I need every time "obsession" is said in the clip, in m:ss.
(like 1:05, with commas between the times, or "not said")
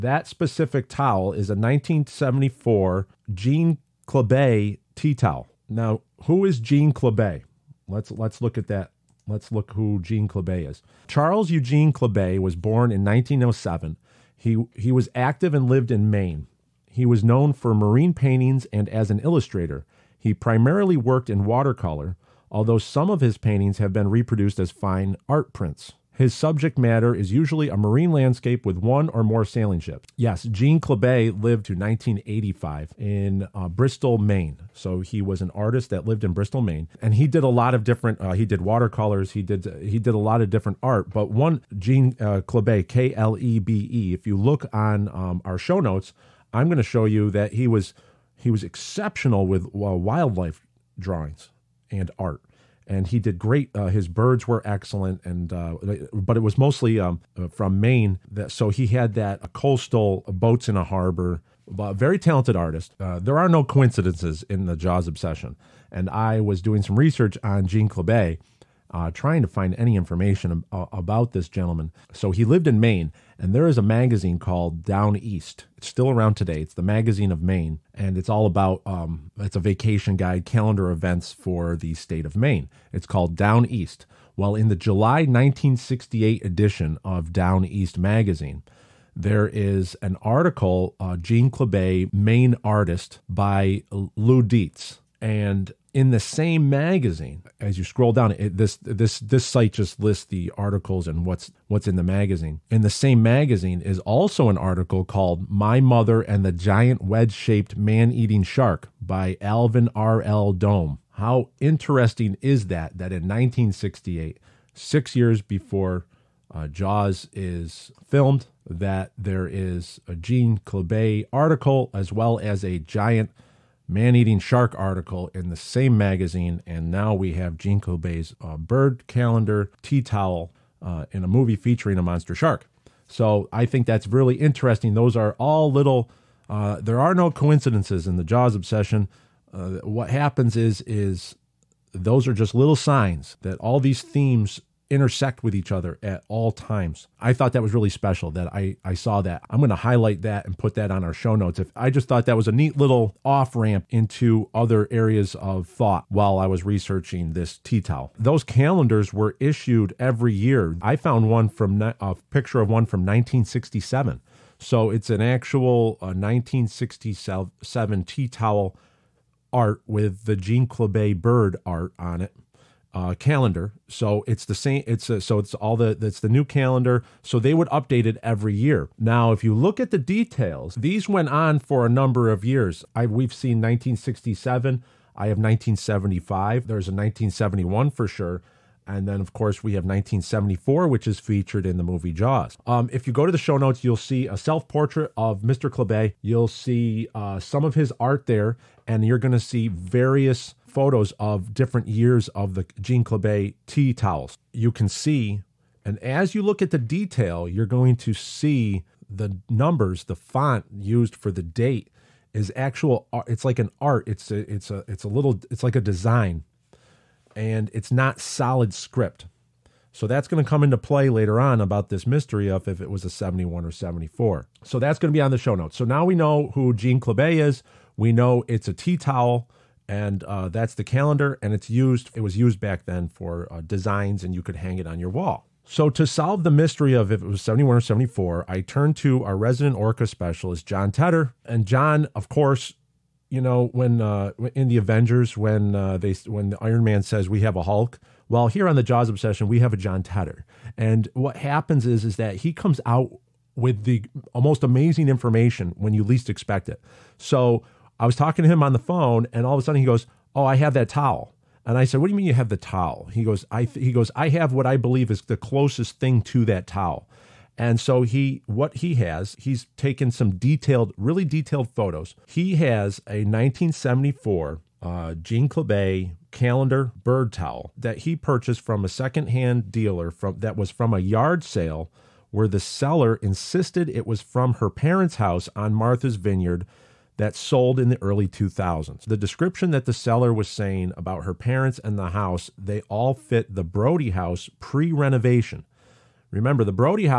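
1:05, 2:18, 4:09.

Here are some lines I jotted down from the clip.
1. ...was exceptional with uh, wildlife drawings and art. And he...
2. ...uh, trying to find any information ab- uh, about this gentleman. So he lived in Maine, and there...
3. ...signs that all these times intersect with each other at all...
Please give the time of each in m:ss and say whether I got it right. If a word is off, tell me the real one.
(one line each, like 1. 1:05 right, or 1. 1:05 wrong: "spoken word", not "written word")
1. 0:48 right
2. 1:08 right
3. 2:22 wrong: "themes", not "times".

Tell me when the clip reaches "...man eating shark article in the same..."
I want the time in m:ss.
2:03.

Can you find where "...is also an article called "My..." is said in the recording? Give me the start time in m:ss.
1:43.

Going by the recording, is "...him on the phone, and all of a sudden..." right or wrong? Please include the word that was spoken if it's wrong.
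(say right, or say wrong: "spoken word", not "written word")
right.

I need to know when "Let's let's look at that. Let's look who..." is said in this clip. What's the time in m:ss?
0:07.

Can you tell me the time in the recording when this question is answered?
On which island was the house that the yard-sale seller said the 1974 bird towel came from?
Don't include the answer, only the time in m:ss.
4:45.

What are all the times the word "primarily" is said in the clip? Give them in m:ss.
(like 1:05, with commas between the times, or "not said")
0:20.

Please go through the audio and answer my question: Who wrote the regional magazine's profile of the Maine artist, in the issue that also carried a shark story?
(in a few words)
Lou Dietz.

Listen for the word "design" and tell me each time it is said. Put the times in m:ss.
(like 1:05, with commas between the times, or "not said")
3:35, 3:53.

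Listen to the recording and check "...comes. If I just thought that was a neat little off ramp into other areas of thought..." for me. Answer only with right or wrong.
wrong.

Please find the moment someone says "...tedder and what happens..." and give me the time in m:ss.
4:10.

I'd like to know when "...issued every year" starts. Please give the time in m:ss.
2:39.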